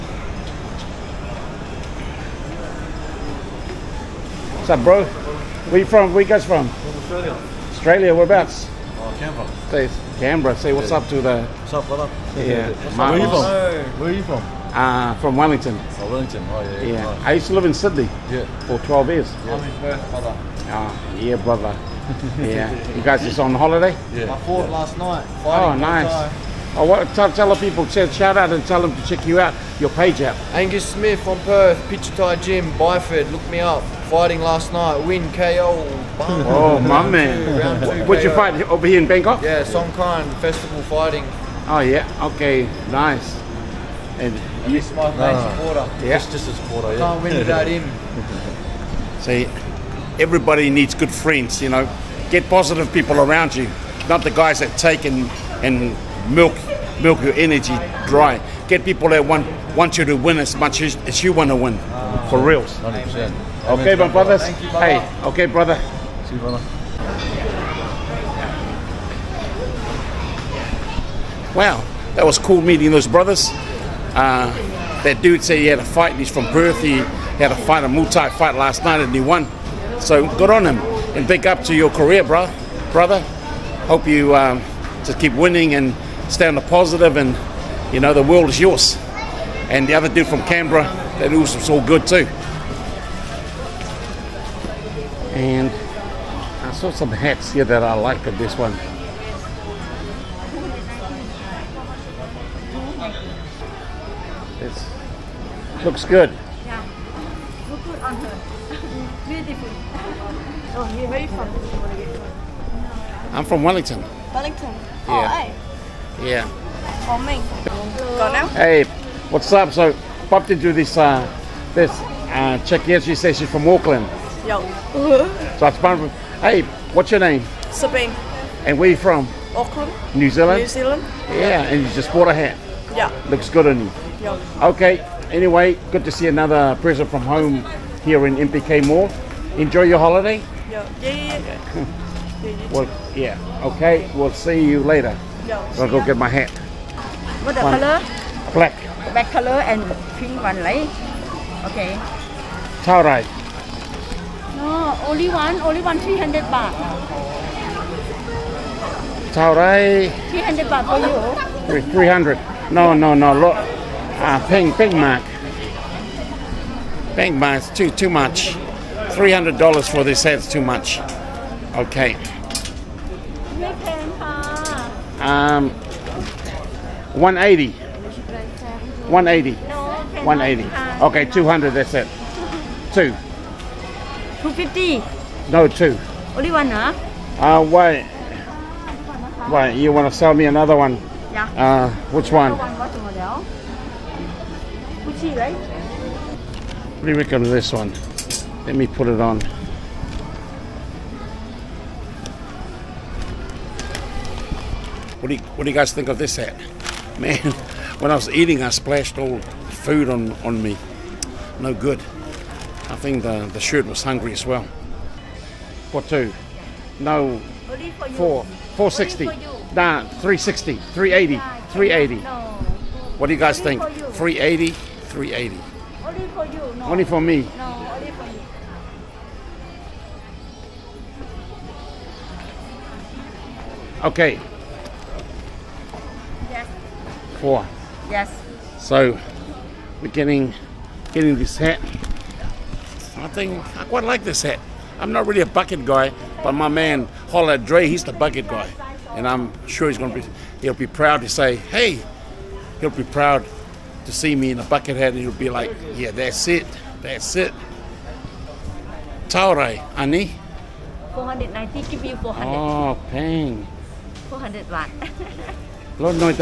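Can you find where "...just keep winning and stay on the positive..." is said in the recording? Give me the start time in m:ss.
1:25.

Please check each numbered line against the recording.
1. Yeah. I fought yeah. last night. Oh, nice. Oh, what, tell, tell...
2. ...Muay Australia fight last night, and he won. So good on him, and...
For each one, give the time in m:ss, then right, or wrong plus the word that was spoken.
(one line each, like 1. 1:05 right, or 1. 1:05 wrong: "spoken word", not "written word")
1. 0:24 right
2. 1:17 wrong: "Thai", not "Australia".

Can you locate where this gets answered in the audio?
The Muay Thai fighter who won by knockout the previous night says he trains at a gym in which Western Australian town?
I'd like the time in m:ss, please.
0:32.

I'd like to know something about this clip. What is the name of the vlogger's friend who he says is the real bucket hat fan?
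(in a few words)
Holla Dre.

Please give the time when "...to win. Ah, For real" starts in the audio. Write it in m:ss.
1:01.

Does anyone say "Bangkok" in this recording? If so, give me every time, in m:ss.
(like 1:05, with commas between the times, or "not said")
0:39.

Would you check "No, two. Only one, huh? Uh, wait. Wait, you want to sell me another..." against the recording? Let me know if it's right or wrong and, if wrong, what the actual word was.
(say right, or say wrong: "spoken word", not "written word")
right.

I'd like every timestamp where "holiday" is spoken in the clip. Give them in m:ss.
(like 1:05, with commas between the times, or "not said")
0:23, 2:19.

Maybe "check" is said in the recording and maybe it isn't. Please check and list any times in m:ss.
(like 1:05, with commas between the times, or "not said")
0:29, 2:02.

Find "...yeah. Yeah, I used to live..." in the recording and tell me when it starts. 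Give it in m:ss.
0:16.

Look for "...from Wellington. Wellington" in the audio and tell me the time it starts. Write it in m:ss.
1:53.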